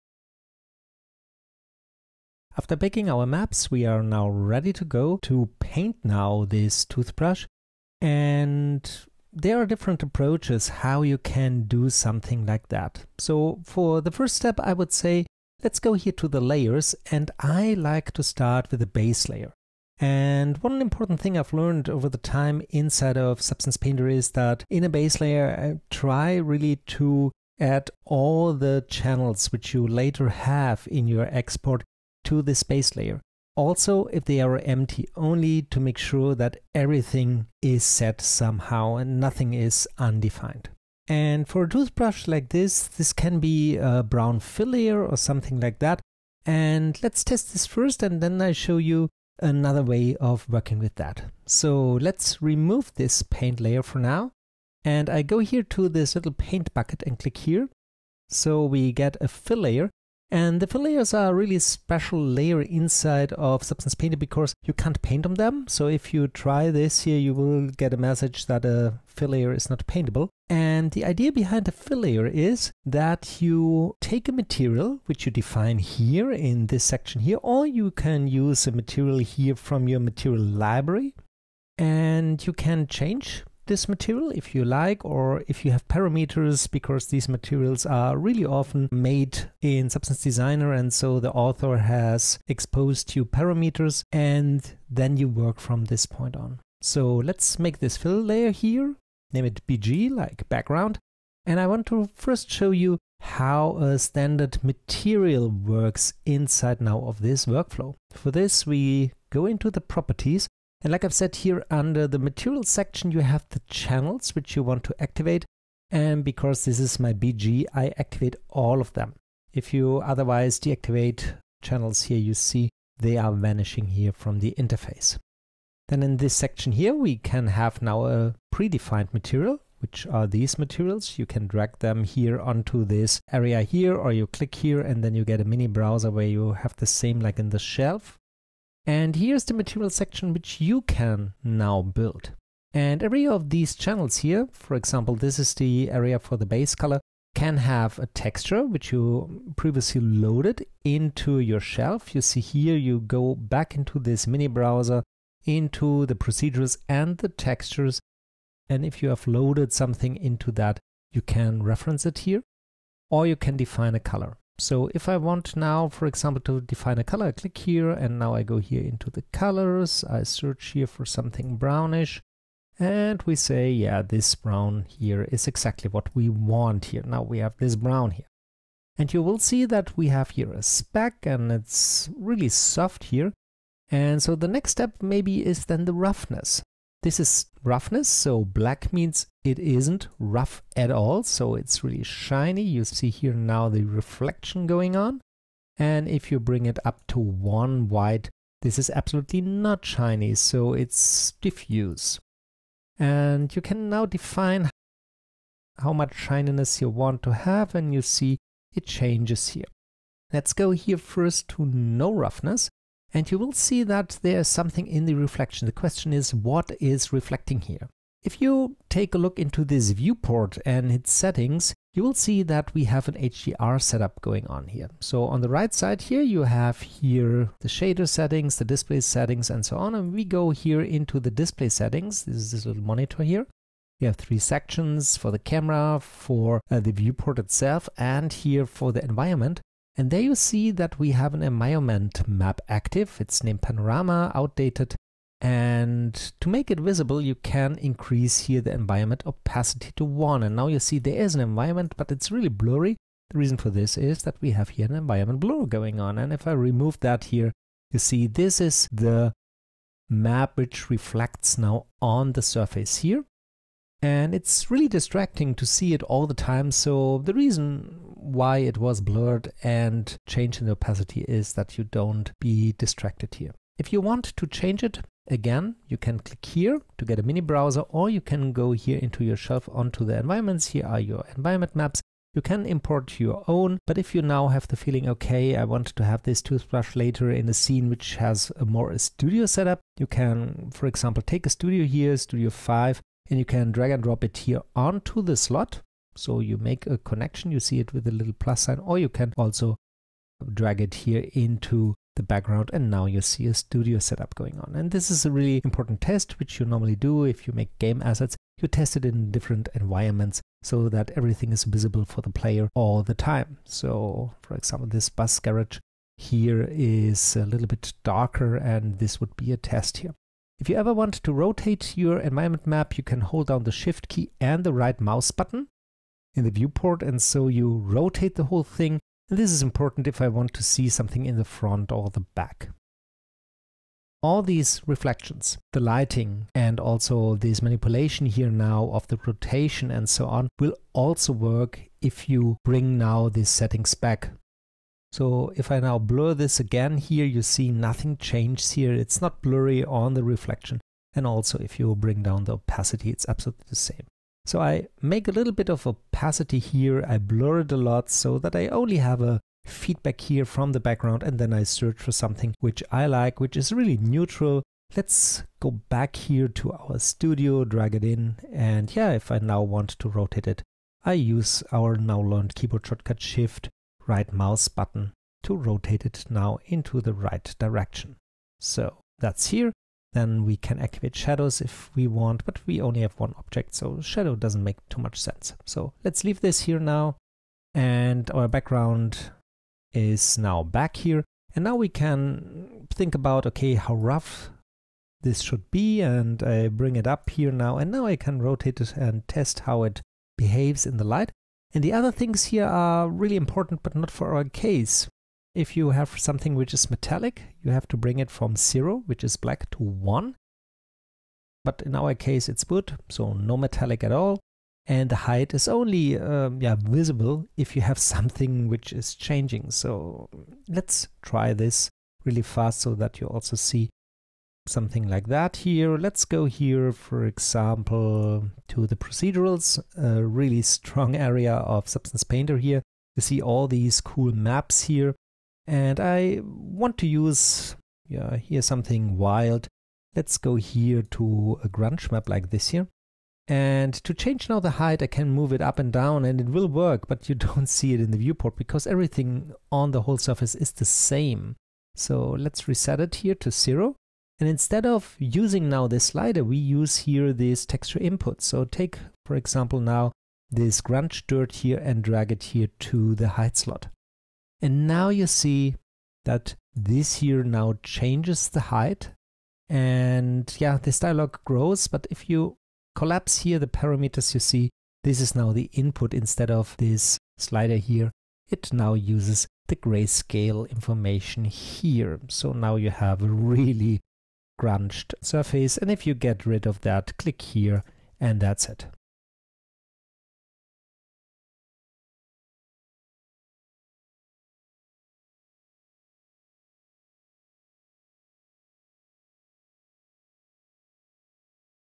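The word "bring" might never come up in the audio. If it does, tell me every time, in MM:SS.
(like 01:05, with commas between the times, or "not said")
03:16, 05:42, 05:51, 06:36, 06:47.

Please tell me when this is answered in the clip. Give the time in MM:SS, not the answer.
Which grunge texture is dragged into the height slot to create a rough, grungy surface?
07:40.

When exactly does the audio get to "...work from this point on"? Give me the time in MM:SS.
01:35.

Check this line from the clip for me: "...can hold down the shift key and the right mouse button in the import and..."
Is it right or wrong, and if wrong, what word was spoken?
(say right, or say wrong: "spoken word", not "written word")
wrong: "viewport", not "import".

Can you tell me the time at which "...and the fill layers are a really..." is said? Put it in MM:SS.
01:00.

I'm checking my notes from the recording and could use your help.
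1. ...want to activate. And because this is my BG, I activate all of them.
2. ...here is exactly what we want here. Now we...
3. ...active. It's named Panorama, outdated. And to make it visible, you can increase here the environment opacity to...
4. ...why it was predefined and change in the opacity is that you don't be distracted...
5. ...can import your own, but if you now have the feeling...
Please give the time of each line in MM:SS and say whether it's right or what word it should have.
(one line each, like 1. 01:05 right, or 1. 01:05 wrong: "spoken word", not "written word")
1. 01:54 right
2. 02:54 right
3. 04:02 right
4. 04:28 wrong: "blurred", not "predefined"
5. 04:42 right.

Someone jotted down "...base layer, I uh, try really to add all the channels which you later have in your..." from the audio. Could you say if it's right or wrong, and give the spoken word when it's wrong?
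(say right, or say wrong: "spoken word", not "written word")
right.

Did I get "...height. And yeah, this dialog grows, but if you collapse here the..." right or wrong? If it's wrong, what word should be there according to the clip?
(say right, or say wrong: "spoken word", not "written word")
right.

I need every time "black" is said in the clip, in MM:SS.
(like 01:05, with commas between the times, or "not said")
03:08, 06:49.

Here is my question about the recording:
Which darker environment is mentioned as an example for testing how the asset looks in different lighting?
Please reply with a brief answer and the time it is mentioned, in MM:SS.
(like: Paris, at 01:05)
bus garage, at 05:15.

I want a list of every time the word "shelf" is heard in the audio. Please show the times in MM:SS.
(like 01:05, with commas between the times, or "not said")
02:17, 02:31, 04:39.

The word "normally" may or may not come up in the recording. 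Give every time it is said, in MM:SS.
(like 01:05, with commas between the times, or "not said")
05:06.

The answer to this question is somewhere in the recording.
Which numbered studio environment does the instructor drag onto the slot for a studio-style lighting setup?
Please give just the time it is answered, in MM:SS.
04:52.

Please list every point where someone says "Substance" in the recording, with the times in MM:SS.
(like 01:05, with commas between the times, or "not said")
00:23, 01:03, 01:29, 07:11.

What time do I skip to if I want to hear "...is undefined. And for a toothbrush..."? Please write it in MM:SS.
00:39.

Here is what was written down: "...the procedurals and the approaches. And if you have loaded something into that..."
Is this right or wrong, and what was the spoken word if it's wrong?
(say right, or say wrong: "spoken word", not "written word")
wrong: "textures", not "approaches".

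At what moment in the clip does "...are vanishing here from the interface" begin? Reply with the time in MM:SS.
02:03.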